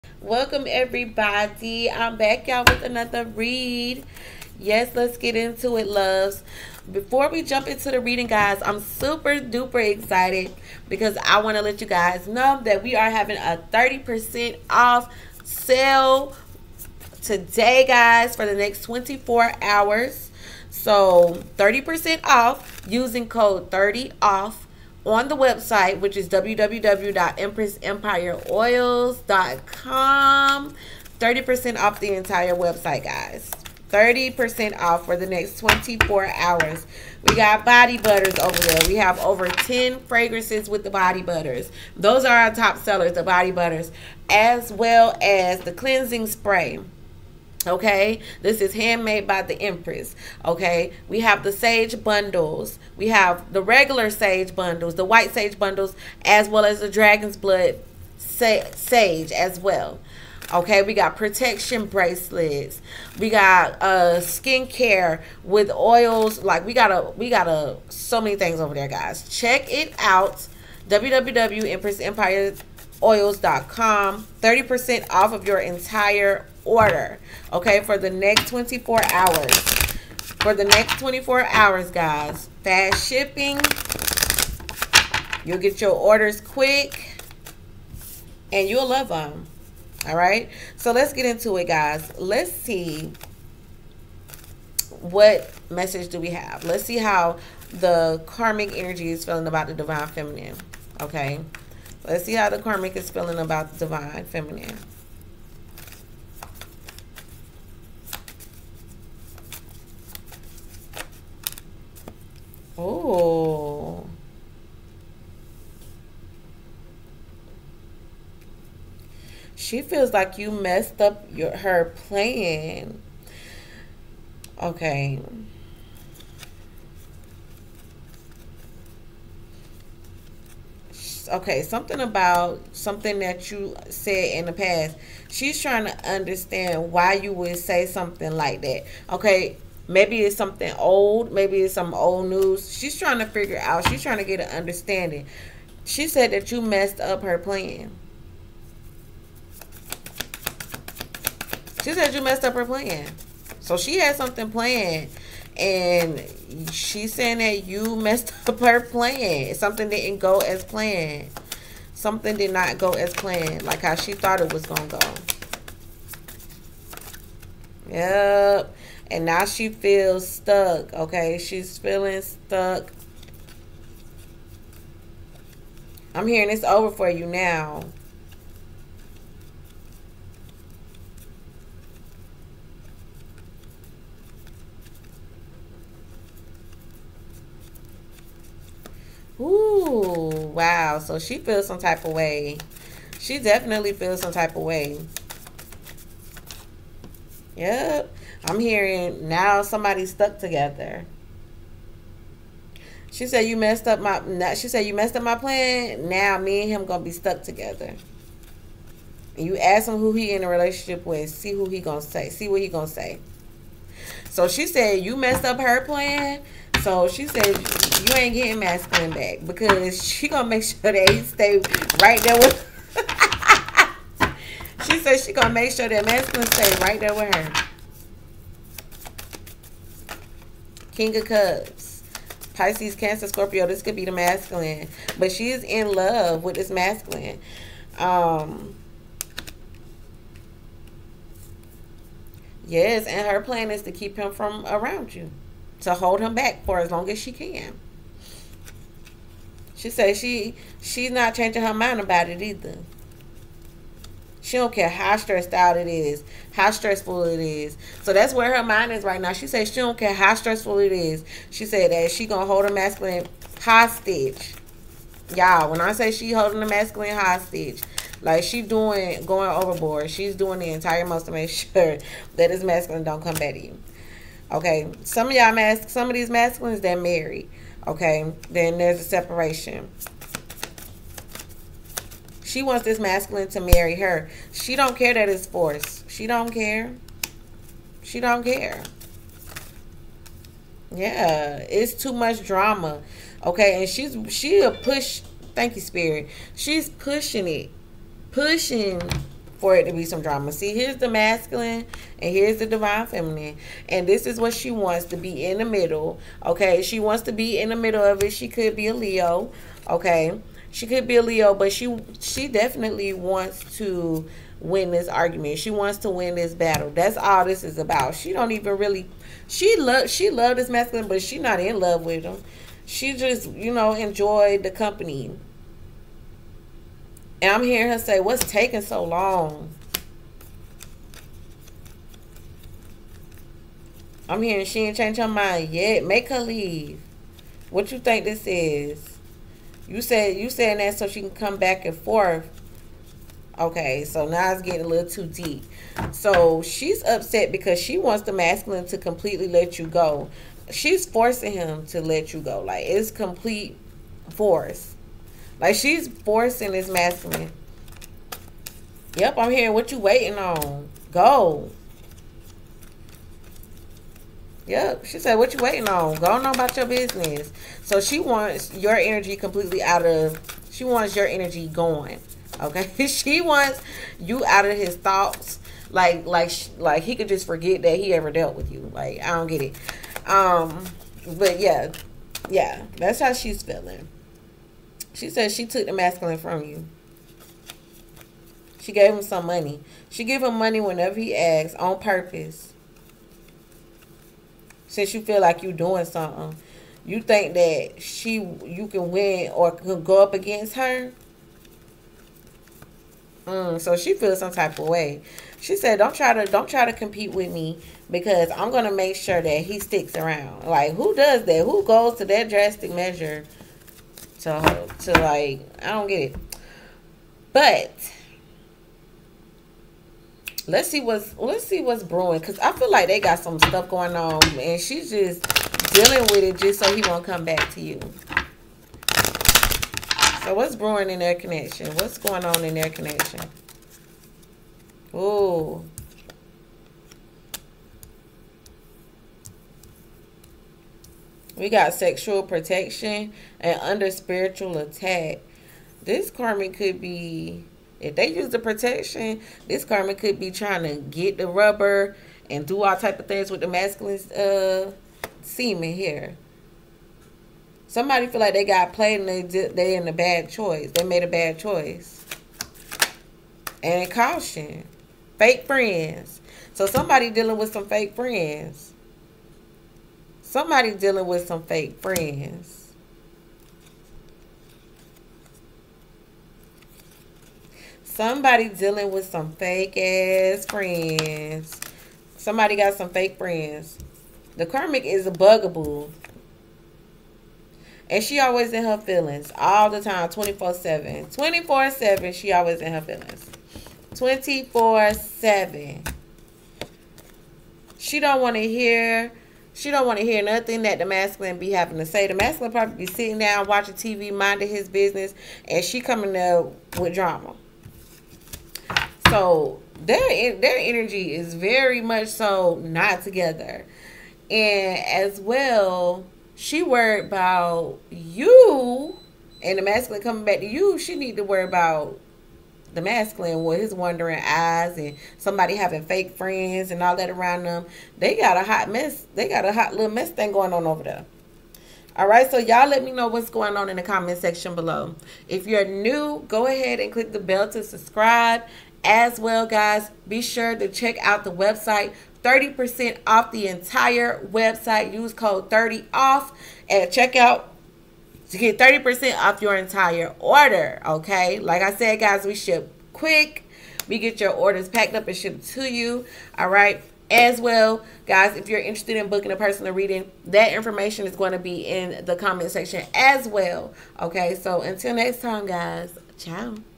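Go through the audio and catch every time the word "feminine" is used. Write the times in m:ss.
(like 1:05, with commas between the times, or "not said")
1:40, 1:44, 5:03.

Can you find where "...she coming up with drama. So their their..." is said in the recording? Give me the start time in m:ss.
8:25.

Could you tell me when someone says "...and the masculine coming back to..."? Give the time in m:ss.
8:39.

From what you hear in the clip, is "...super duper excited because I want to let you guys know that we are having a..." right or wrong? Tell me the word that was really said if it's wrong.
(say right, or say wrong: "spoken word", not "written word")
right.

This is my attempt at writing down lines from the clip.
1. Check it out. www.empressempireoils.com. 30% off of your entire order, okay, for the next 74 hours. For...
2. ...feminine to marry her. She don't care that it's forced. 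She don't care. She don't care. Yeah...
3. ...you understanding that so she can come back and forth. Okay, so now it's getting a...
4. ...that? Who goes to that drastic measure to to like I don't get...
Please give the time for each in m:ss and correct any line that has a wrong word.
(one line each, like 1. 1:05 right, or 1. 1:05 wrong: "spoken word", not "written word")
1. 1:09 wrong: "24", not "74"
2. 4:42 wrong: "masculine", not "feminine"
3. 5:40 wrong: "saying", not "understanding"
4. 6:51 right.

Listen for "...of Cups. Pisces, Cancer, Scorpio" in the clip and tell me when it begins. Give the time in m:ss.
3:51.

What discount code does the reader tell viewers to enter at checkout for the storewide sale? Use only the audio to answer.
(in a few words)
30OFF.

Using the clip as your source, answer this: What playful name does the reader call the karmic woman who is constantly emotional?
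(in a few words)
Bugaboo.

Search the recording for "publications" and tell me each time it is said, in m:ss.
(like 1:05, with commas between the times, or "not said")
not said.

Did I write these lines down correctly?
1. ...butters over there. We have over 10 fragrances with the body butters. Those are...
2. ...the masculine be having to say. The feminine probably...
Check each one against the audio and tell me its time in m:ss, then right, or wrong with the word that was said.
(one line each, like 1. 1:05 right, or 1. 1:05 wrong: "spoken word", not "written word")
1. 0:37 right
2. 8:20 wrong: "masculine", not "feminine".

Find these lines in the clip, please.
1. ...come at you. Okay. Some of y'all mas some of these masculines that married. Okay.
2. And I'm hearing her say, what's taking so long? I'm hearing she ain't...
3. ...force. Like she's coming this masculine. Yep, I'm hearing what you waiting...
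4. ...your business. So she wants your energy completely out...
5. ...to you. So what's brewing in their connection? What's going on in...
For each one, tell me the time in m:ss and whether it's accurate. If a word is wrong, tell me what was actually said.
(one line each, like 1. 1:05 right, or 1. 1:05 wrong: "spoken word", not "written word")
1. 4:33 right
2. 5:27 right
3. 5:54 wrong: "forcing", not "coming"
4. 6:06 right
5. 7:07 right.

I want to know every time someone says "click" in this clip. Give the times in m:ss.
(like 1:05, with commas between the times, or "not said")
8:57.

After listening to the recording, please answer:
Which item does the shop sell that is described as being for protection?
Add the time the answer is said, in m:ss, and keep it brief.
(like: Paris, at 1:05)
Bracelets, at 1:01.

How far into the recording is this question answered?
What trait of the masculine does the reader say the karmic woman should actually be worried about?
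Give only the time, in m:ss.
8:43.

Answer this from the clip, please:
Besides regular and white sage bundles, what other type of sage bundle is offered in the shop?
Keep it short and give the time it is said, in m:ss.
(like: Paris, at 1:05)
Dragon's blood sage, at 0:56.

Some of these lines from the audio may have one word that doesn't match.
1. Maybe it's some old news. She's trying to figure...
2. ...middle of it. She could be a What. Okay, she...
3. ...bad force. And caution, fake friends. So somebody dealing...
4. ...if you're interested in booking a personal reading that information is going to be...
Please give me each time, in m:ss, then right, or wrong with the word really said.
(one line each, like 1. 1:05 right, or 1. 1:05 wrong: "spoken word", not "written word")
1. 2:21 right
2. 5:07 wrong: "Leo", not "What"
3. 7:41 wrong: "choice", not "force"
4. 9:18 right.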